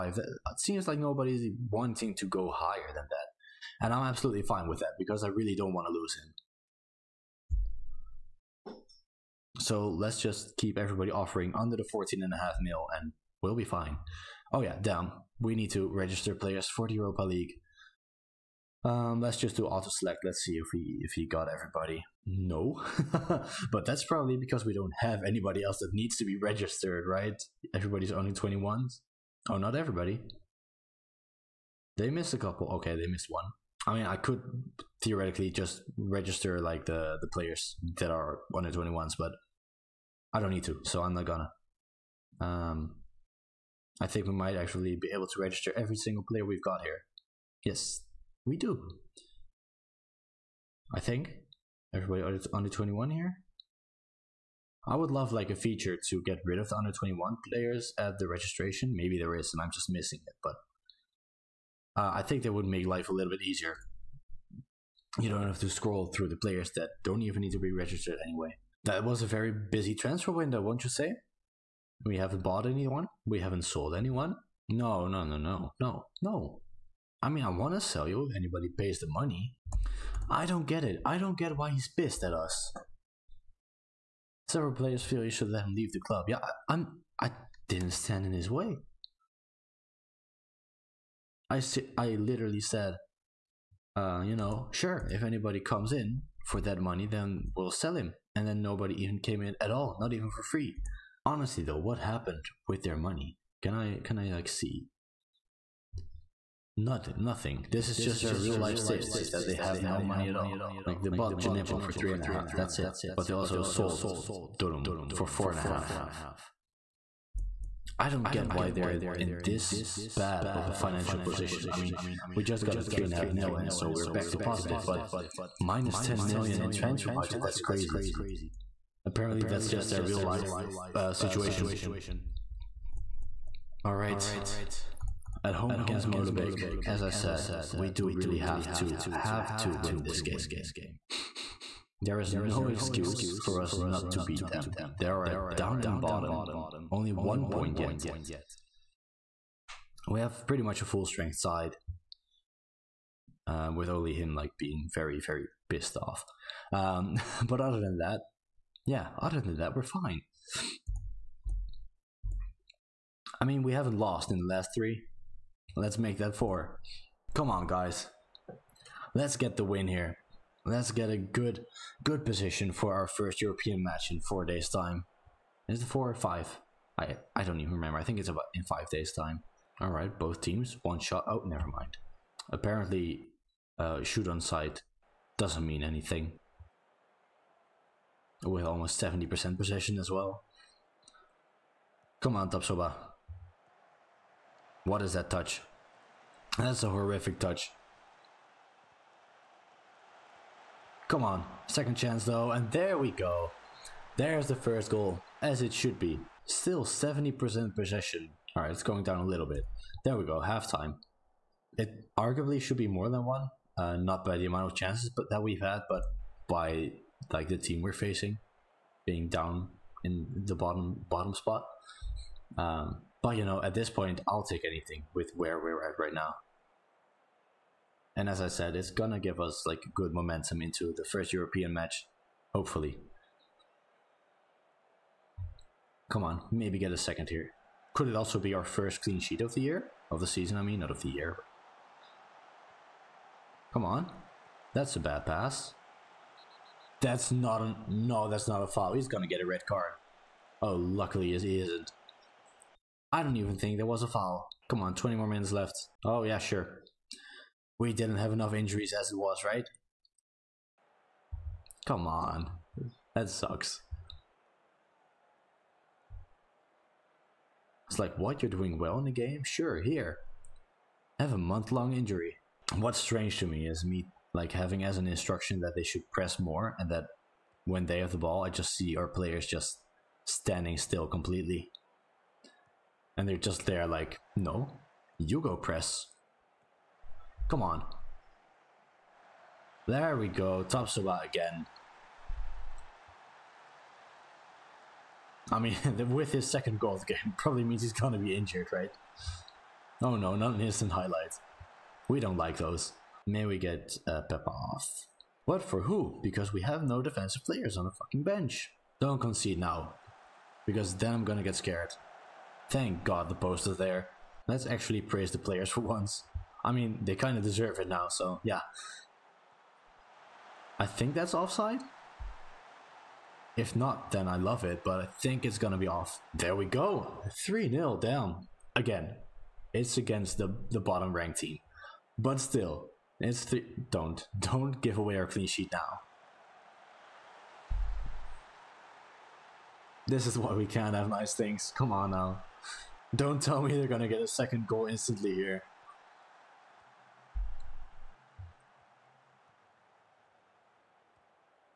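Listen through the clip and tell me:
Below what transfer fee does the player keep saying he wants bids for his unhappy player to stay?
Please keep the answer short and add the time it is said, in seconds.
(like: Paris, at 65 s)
14 and a half million, at 11 s.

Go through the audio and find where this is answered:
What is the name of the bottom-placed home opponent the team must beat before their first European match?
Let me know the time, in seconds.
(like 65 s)
136 s.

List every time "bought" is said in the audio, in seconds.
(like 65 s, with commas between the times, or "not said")
72 s, 111 s.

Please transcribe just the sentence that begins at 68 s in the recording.
That was a very busy transfer window, won't you say?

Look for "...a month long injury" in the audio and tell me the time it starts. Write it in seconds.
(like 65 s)
271 s.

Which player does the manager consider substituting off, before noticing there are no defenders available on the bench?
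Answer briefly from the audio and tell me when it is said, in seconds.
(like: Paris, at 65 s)
Peppa, at 304 s.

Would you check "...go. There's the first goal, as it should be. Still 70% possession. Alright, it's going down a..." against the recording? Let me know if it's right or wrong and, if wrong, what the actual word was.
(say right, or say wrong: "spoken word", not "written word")
right.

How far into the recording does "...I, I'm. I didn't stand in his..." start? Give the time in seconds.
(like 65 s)
86 s.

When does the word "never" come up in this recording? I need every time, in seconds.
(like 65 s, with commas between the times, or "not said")
181 s.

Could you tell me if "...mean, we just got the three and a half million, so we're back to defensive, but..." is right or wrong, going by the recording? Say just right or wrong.
wrong.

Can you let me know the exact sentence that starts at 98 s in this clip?
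And then nobody even came in at all, not even for free honestly though, what happened with their money?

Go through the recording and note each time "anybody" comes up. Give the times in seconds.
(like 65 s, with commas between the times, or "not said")
25 s, 78 s, 95 s.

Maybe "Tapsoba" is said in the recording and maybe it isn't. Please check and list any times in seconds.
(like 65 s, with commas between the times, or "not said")
192 s, 290 s.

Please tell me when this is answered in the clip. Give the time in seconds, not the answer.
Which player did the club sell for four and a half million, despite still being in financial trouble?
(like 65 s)
114 s.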